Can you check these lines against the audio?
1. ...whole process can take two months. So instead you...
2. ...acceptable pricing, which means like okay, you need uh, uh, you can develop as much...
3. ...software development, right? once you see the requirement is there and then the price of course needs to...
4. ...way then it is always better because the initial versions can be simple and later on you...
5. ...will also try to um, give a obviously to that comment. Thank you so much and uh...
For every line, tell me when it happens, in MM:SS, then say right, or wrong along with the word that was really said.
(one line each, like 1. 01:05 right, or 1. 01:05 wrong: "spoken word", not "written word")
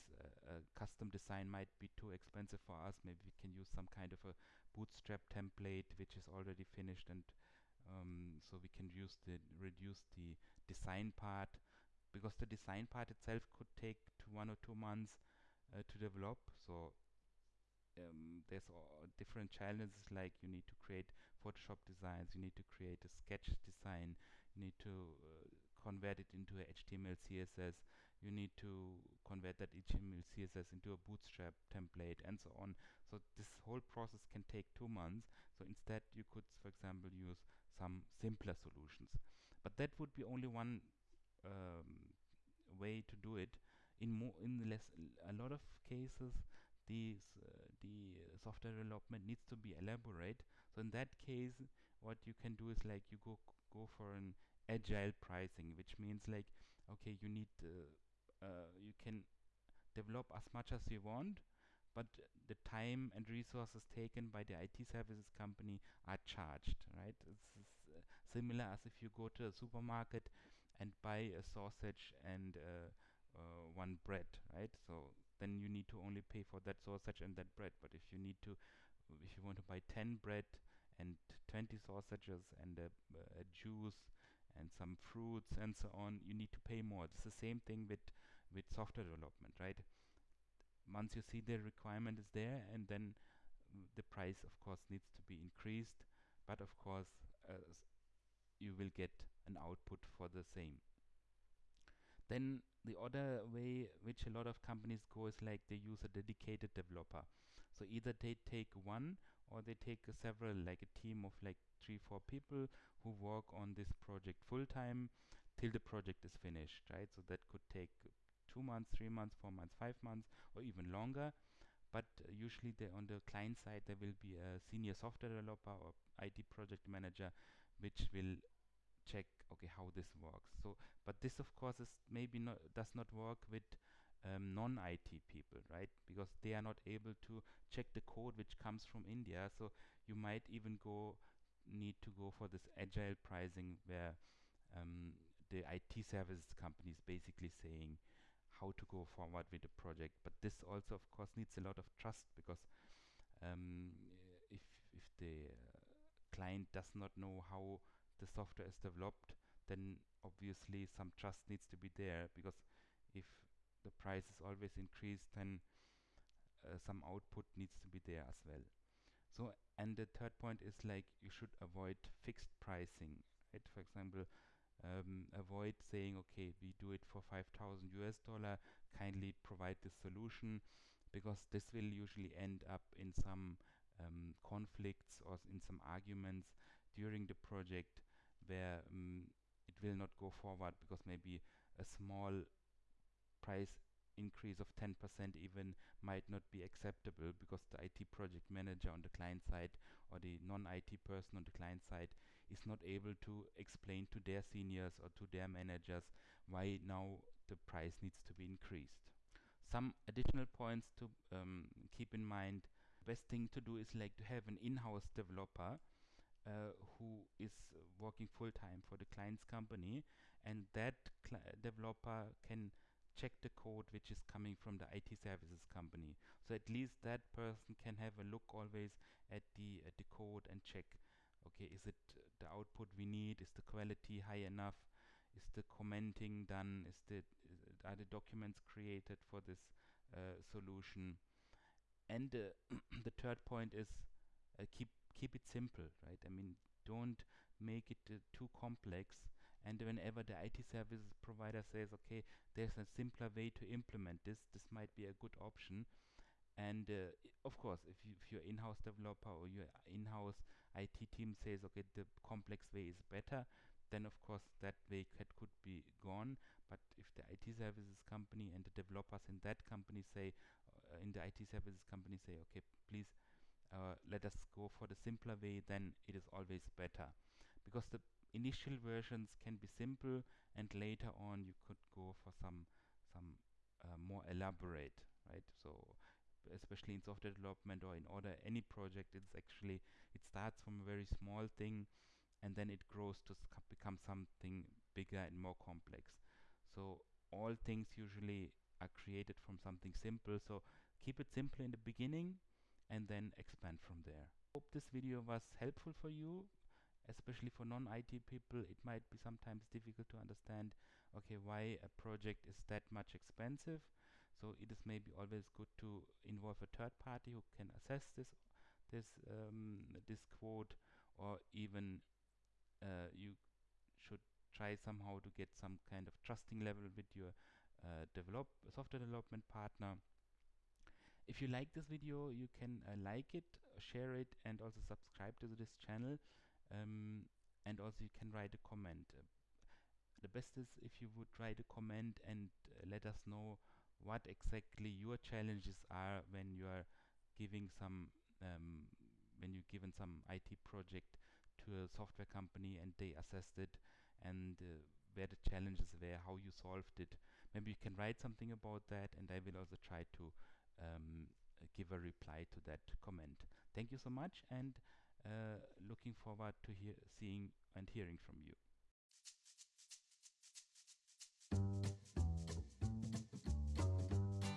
1. 00:33 right
2. 00:54 wrong: "agile", not "acceptable"
3. 01:28 right
4. 04:35 right
5. 05:59 wrong: "reply", not "obviously".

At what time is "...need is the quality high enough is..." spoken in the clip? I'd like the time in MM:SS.
03:53.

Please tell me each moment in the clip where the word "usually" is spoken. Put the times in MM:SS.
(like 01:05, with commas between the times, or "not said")
02:02, 03:01, 04:57.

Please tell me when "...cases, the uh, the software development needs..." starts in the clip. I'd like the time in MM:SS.
00:45.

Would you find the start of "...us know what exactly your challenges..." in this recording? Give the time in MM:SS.
05:43.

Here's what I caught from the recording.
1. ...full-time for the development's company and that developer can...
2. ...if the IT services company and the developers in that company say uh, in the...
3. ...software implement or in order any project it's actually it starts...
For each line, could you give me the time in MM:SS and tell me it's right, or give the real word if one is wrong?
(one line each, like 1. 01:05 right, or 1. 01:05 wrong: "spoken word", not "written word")
1. 03:38 wrong: "client", not "development"
2. 04:26 right
3. 04:47 wrong: "development", not "implement".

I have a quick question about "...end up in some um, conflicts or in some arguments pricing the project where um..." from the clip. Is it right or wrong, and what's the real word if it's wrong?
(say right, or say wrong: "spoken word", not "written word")
wrong: "during", not "pricing".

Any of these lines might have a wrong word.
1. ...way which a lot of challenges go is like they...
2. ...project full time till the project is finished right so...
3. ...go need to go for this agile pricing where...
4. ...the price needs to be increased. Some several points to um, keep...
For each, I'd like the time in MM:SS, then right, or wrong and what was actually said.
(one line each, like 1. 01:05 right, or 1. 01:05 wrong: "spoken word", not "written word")
1. 01:43 wrong: "companies", not "challenges"
2. 01:53 right
3. 02:20 right
4. 03:27 wrong: "additional", not "several".